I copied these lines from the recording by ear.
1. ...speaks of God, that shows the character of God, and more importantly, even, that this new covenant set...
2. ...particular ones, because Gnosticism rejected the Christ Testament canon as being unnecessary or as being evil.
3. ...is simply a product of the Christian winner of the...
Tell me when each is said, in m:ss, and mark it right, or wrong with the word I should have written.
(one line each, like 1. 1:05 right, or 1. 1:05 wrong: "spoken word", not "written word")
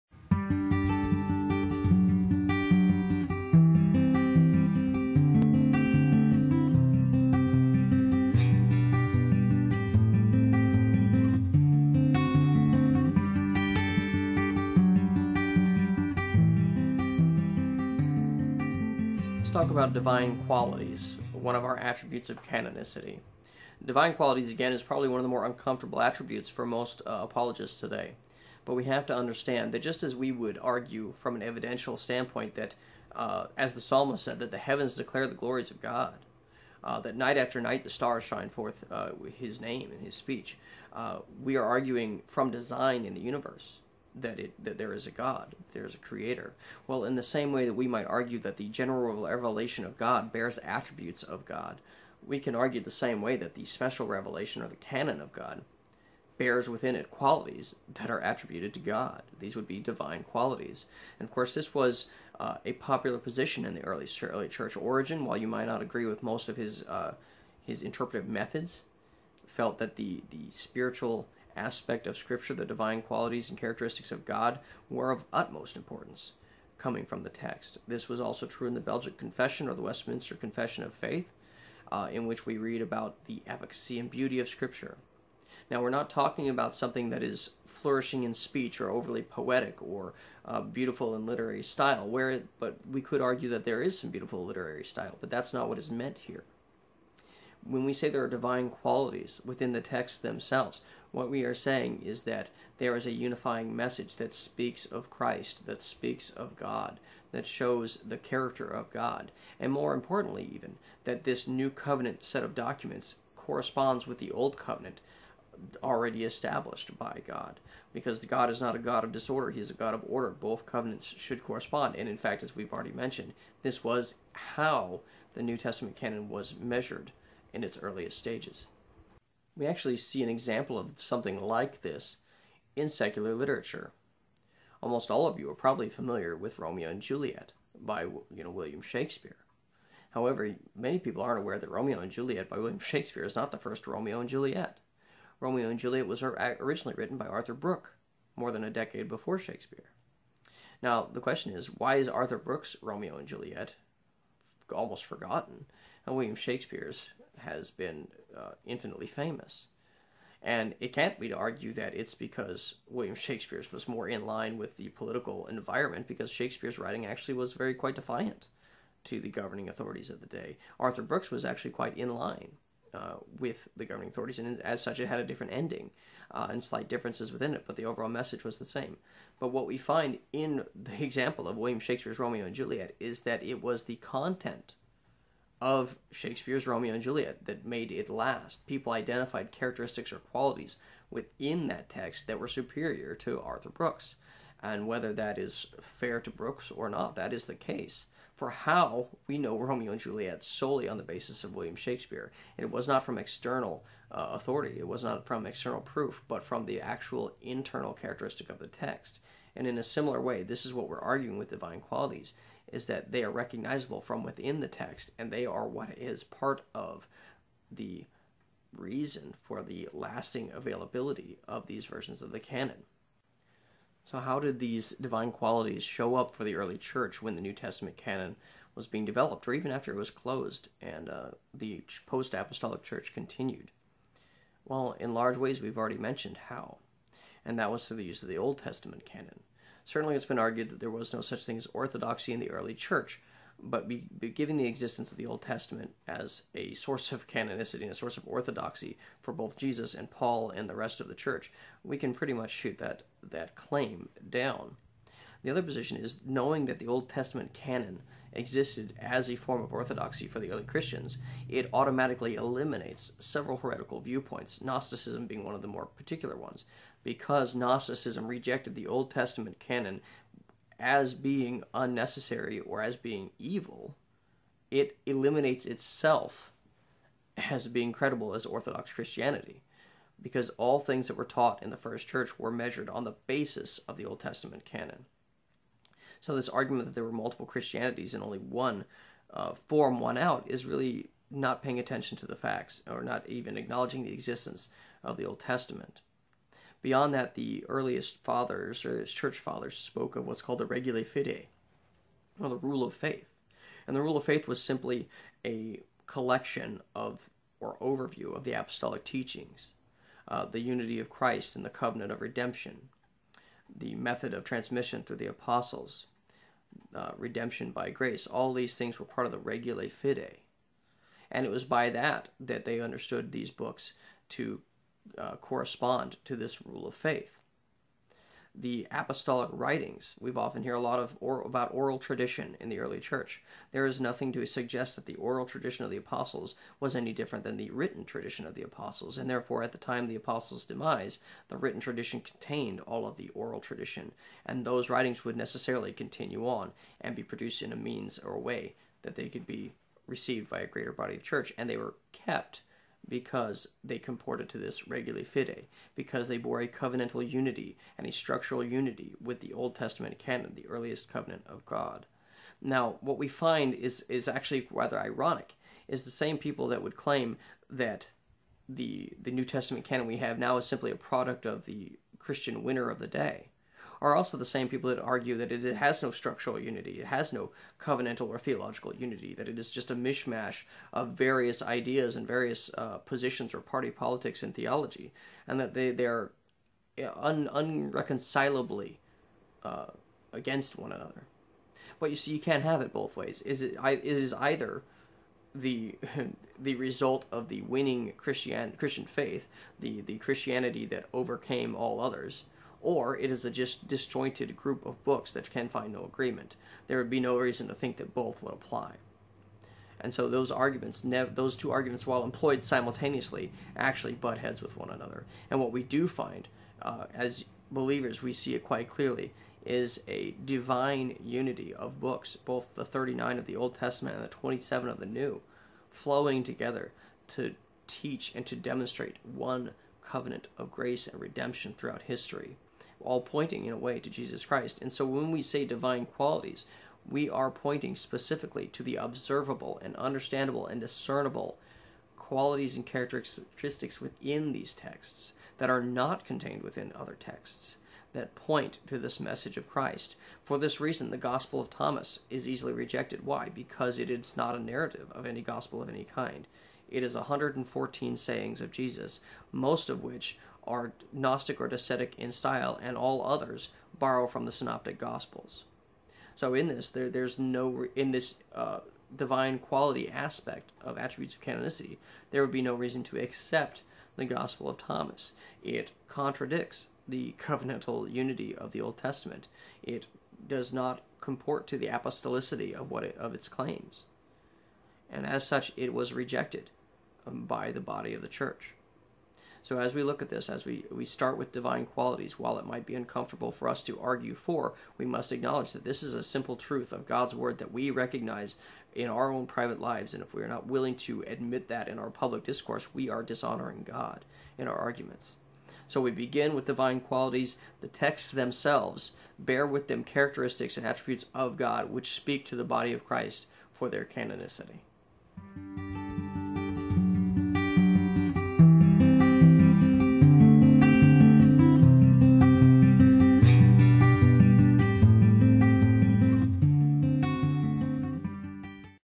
1. 1:45 right
2. 4:25 wrong: "Old", not "Christ"
3. 6:10 right.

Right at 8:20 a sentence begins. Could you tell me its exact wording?
And if we are not willing to admit that in our public discourse, we are dishonoring God in our arguments.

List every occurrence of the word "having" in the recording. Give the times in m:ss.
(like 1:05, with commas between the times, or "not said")
not said.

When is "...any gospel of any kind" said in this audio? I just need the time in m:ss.
7:35.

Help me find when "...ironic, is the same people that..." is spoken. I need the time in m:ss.
6:04.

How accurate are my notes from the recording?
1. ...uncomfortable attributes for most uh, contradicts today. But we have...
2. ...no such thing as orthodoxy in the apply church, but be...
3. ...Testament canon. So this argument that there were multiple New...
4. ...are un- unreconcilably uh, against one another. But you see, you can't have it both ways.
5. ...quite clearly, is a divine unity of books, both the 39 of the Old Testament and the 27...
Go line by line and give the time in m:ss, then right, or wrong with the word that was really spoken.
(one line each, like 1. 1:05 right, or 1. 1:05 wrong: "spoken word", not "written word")
1. 0:25 wrong: "apologists", not "contradicts"
2. 4:01 wrong: "early", not "apply"
3. 4:44 wrong: "Christianities", not "New"
4. 6:26 right
5. 6:58 right.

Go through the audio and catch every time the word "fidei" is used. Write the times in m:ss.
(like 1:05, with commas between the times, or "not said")
5:01, 5:19, 5:55.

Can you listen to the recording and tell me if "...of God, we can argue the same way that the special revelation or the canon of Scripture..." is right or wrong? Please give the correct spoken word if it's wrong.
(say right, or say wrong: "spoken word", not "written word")
wrong: "God", not "Scripture".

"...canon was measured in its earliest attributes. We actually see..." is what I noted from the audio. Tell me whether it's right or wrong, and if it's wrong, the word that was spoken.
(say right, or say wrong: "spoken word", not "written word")
wrong: "stages", not "attributes".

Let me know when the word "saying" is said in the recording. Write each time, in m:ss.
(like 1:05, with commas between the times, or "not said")
1:41, 7:38.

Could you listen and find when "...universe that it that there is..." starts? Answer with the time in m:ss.
0:43.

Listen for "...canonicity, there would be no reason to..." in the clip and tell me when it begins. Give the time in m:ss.
7:51.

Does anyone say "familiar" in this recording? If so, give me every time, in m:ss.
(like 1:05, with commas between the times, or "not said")
2:15.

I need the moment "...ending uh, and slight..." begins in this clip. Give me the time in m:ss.
2:55.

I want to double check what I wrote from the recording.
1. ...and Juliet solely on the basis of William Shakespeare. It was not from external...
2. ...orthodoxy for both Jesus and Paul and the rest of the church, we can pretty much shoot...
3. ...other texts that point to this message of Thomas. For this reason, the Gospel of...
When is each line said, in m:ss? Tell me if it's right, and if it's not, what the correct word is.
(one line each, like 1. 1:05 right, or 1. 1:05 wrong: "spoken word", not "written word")
1. 3:19 right
2. 4:08 right
3. 7:26 wrong: "Christ", not "Thomas".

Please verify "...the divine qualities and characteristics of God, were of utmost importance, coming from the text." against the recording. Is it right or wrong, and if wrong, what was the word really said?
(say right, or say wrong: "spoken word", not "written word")
right.